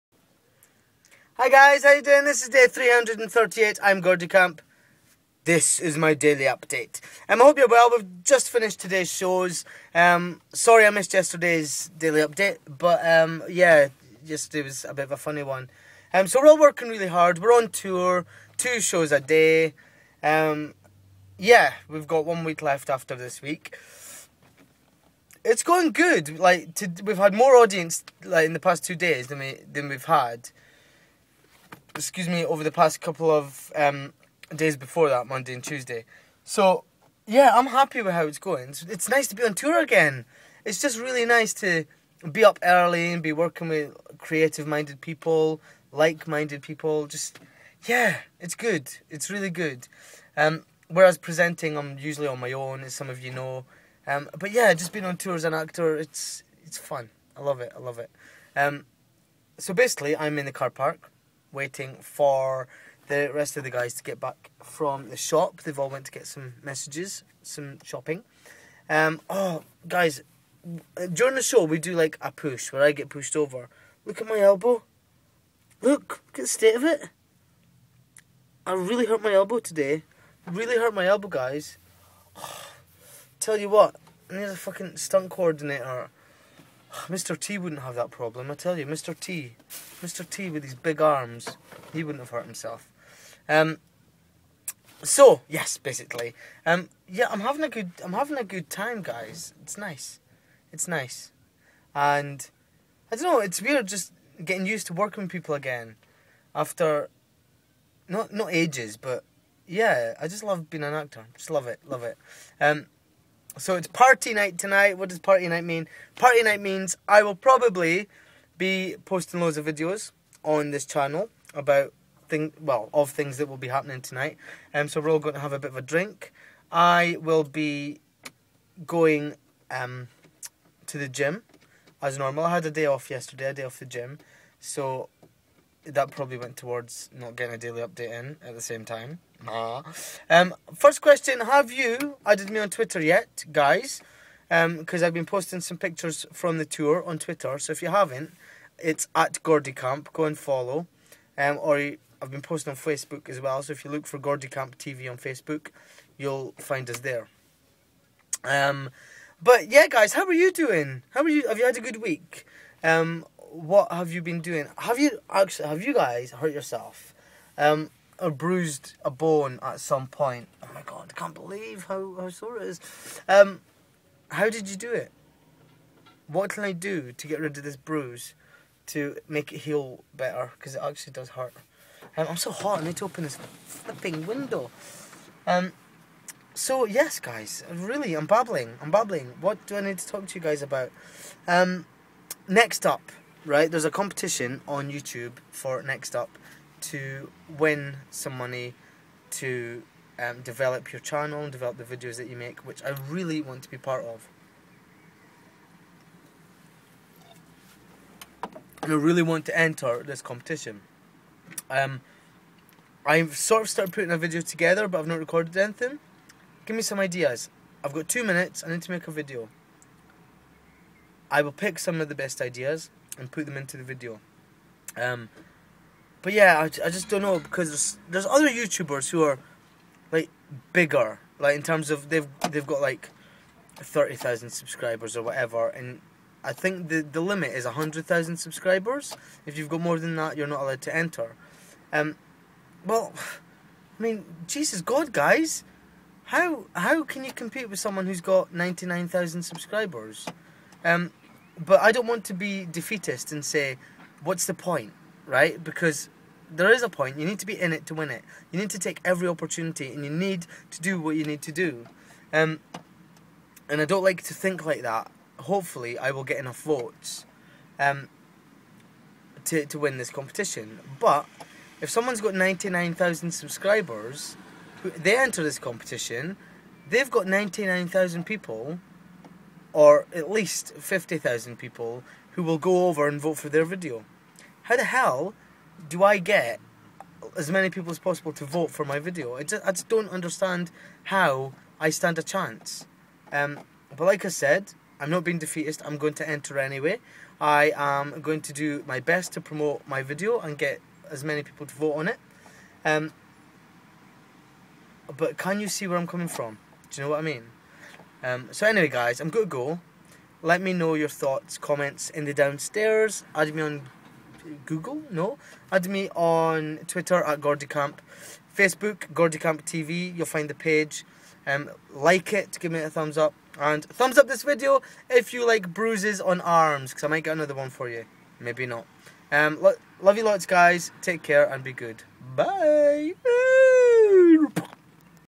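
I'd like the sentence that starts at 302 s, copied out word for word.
Um, but can you see where I'm coming from?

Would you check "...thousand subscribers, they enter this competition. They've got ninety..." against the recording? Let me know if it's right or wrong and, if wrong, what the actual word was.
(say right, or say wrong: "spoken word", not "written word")
right.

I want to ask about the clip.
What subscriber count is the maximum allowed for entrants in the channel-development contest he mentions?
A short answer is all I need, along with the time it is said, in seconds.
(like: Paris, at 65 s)
100,000, at 237 s.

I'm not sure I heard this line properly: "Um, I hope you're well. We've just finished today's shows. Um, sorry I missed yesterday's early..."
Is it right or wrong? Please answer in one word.
wrong.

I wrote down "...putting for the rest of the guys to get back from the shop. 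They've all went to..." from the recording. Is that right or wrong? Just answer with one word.
wrong.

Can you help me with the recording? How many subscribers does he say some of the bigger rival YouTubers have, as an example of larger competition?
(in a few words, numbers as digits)
30,000.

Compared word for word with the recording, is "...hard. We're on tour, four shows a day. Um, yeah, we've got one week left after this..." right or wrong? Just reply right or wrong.
wrong.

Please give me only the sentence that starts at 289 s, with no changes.
I just, I just don't understand how I stand a chance.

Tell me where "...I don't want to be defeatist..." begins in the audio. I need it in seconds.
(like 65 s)
251 s.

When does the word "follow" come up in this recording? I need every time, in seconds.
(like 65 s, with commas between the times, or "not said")
150 s.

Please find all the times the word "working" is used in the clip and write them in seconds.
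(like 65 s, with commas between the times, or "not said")
16 s, 43 s, 104 s.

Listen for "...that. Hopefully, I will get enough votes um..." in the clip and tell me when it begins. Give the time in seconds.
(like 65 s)
264 s.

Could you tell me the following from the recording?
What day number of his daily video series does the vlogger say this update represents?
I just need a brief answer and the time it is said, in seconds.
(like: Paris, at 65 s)
338, at 2 s.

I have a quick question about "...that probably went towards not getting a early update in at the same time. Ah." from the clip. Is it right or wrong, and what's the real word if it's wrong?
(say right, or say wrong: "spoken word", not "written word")
wrong: "daily", not "early".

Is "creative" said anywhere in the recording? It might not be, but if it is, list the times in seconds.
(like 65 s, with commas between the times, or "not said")
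44 s.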